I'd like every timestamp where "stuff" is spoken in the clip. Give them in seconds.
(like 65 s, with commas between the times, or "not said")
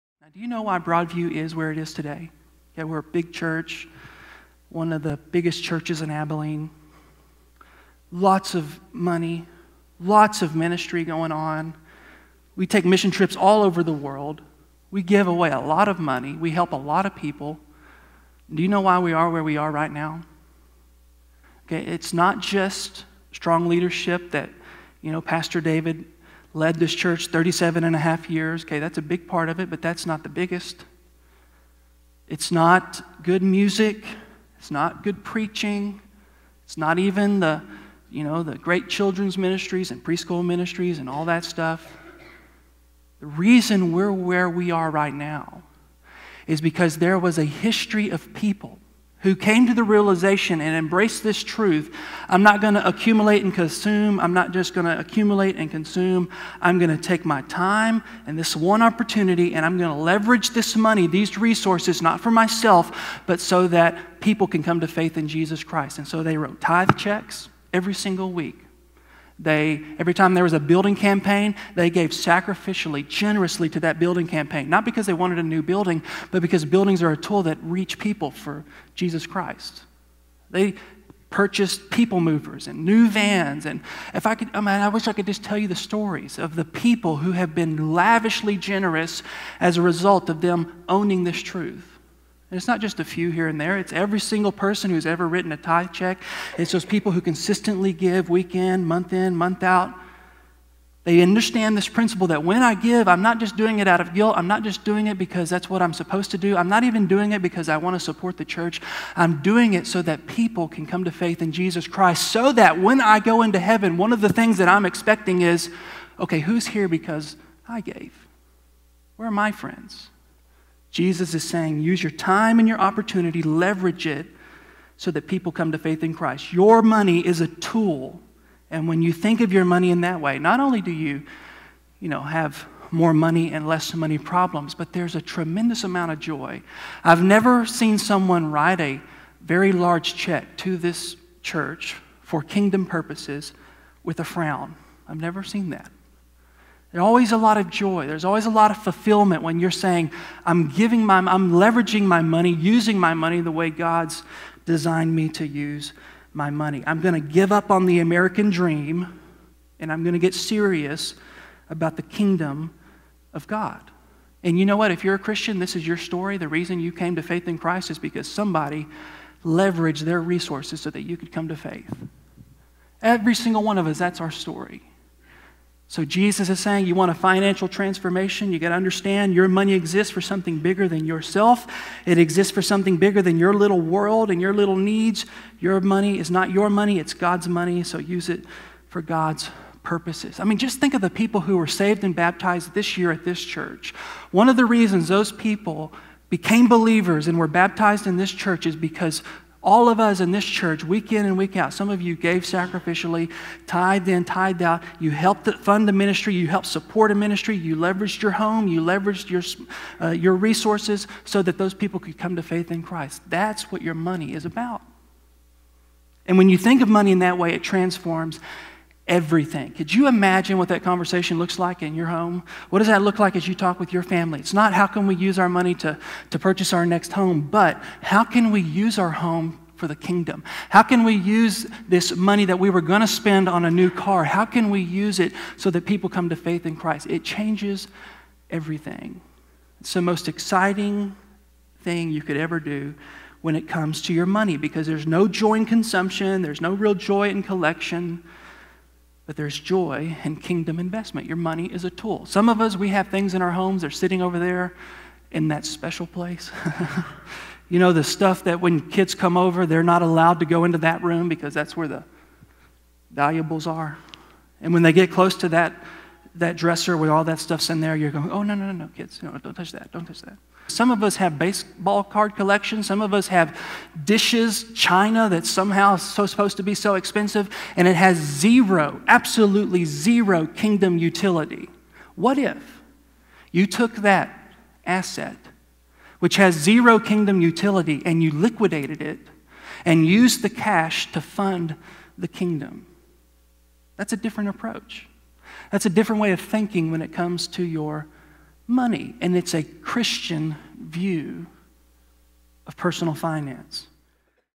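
41 s, 258 s, 267 s.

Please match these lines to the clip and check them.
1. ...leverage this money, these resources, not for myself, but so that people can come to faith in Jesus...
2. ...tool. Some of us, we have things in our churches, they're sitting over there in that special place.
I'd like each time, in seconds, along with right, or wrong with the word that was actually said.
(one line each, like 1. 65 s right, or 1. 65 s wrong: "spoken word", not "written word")
1. 60 s right
2. 251 s wrong: "homes", not "churches".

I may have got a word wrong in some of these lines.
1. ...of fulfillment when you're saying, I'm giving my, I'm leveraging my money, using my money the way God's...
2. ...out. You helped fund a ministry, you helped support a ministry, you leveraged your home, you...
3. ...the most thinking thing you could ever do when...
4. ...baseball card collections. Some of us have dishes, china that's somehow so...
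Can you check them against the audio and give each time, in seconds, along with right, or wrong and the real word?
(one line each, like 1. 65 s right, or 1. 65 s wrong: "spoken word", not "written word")
1. 148 s right
2. 204 s right
3. 239 s wrong: "exciting", not "thinking"
4. 271 s right.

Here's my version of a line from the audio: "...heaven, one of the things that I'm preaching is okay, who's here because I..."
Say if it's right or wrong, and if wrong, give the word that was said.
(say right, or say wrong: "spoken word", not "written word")
wrong: "expecting", not "preaching".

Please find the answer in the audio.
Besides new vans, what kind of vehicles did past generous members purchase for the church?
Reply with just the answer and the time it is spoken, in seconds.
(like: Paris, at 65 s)
people movers, at 81 s.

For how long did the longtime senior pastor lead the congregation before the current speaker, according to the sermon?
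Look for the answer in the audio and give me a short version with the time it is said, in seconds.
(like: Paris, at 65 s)
37 and a half years, at 27 s.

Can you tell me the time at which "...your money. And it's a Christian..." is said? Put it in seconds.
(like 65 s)
297 s.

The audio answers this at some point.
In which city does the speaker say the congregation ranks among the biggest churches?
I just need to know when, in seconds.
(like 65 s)
6 s.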